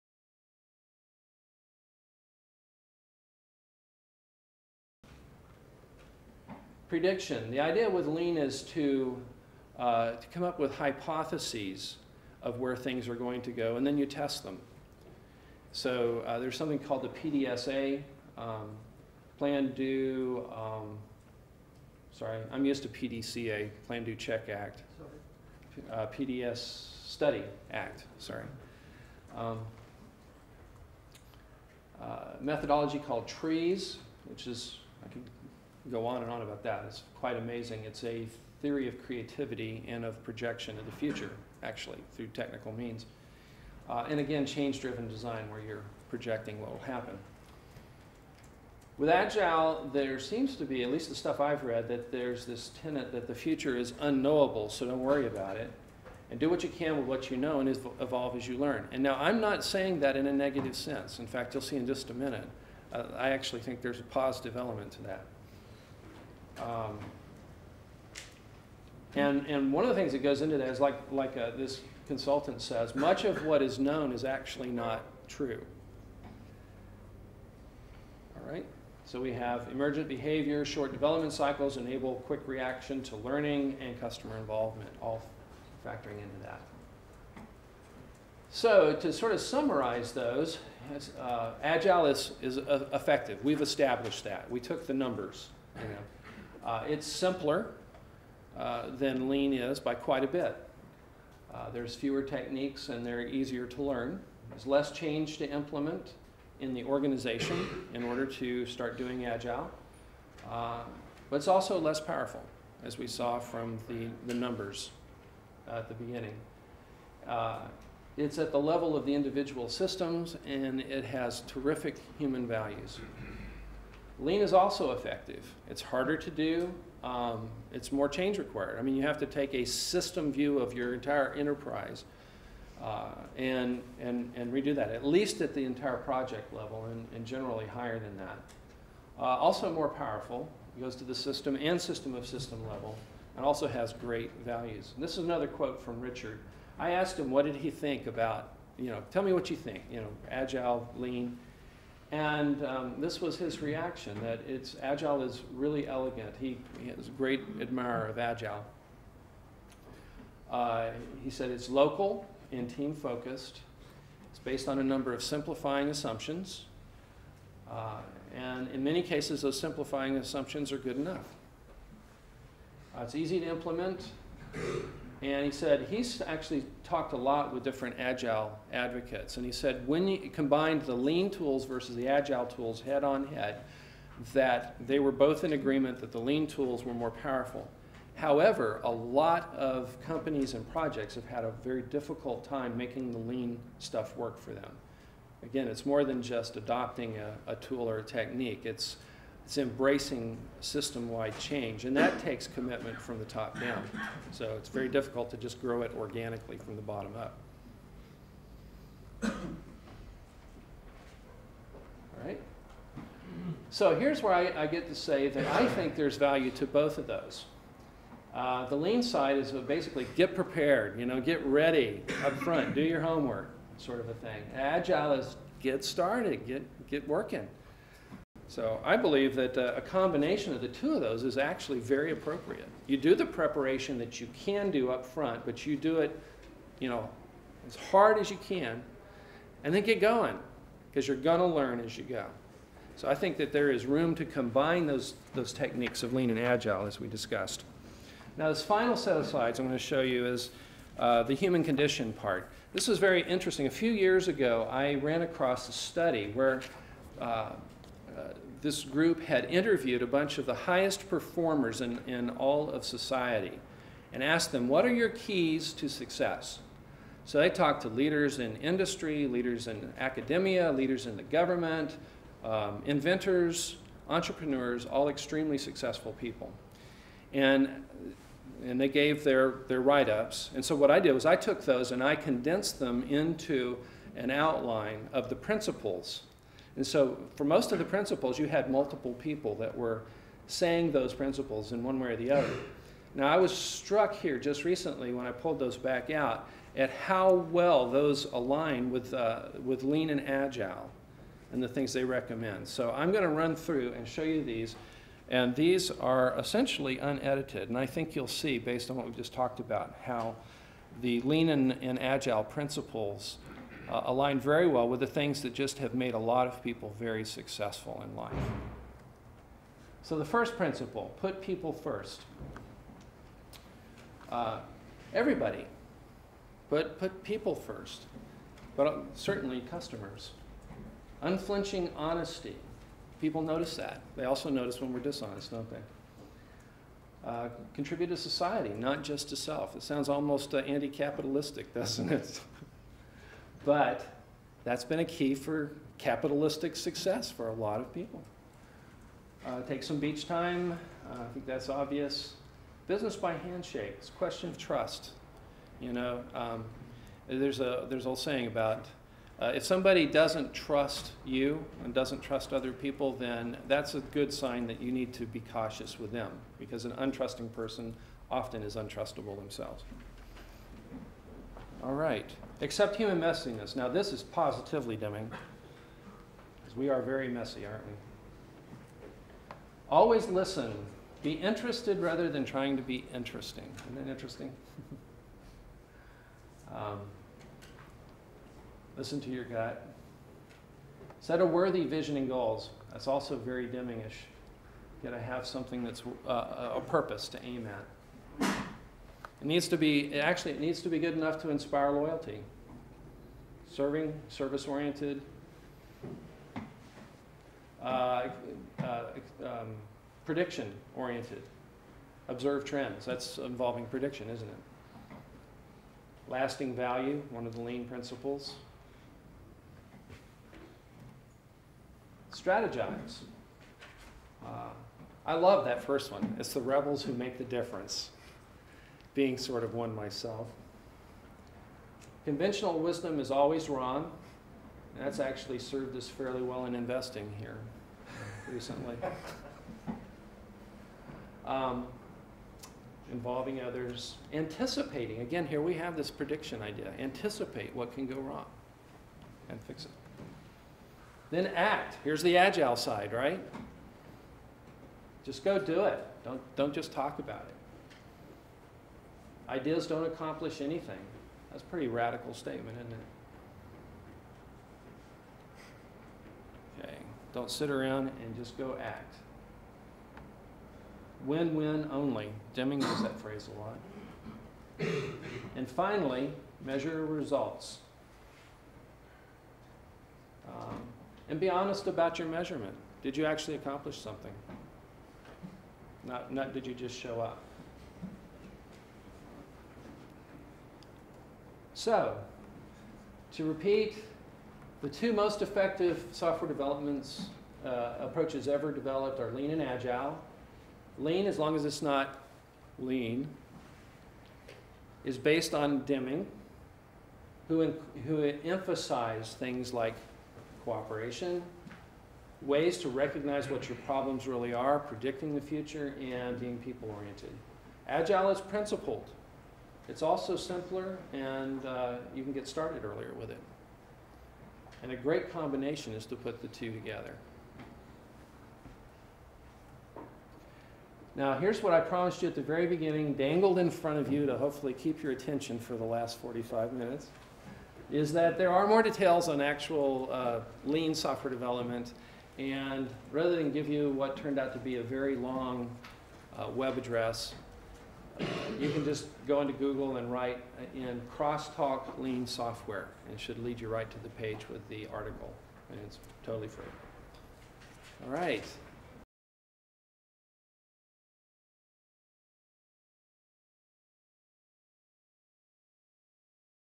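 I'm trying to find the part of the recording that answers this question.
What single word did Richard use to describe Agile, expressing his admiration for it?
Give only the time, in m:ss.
2:35.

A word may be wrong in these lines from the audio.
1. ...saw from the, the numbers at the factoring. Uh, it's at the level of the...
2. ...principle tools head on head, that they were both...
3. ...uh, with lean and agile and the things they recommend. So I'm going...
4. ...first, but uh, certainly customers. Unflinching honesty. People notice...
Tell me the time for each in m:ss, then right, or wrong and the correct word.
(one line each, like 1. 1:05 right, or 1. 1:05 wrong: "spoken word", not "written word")
1. 1:53 wrong: "beginning", not "factoring"
2. 3:02 wrong: "agile", not "principle"
3. 4:59 right
4. 5:27 right.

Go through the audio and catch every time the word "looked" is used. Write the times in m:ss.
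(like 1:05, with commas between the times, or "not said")
not said.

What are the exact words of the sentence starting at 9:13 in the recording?
And it should lead you right to the page with the article.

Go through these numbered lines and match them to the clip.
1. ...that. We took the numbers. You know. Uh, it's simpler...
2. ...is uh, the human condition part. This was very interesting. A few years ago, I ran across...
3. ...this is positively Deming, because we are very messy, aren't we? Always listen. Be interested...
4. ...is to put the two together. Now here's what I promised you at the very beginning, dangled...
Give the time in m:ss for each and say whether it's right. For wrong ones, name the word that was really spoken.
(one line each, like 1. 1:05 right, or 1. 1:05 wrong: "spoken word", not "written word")
1. 1:34 right
2. 4:10 right
3. 6:13 right
4. 8:45 right.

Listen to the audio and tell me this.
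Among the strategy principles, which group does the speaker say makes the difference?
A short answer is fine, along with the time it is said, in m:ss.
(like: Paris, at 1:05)
the rebels, at 7:06.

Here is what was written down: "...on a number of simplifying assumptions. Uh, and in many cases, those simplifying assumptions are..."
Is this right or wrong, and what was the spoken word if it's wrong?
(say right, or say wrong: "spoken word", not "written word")
right.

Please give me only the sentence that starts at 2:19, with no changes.
Uh, also more powerful, goes to the system and system of system level, and also has great values.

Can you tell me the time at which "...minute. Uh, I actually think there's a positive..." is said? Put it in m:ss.
1:02.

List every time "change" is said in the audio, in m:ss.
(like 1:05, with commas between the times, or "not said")
0:44, 1:44, 2:08, 3:21.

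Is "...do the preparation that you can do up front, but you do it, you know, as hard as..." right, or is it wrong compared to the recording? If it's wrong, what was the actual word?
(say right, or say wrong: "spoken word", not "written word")
right.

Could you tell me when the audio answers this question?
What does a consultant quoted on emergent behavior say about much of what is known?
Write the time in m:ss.
1:14.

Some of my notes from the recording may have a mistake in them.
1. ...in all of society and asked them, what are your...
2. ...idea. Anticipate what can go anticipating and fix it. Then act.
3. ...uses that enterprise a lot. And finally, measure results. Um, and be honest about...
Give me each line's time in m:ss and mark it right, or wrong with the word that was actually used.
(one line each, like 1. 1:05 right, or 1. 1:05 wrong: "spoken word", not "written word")
1. 4:22 right
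2. 7:26 wrong: "wrong", not "anticipating"
3. 7:52 wrong: "phrase", not "enterprise".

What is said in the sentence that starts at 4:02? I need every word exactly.
So I think that there is room to combine those, those techniques of lean and agile as we discussed.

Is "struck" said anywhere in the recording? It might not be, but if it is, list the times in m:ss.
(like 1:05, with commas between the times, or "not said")
4:53.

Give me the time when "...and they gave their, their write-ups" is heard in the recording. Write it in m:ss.
4:38.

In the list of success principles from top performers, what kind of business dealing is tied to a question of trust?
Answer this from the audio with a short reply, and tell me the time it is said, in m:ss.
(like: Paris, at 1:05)
Business by handshake, at 5:52.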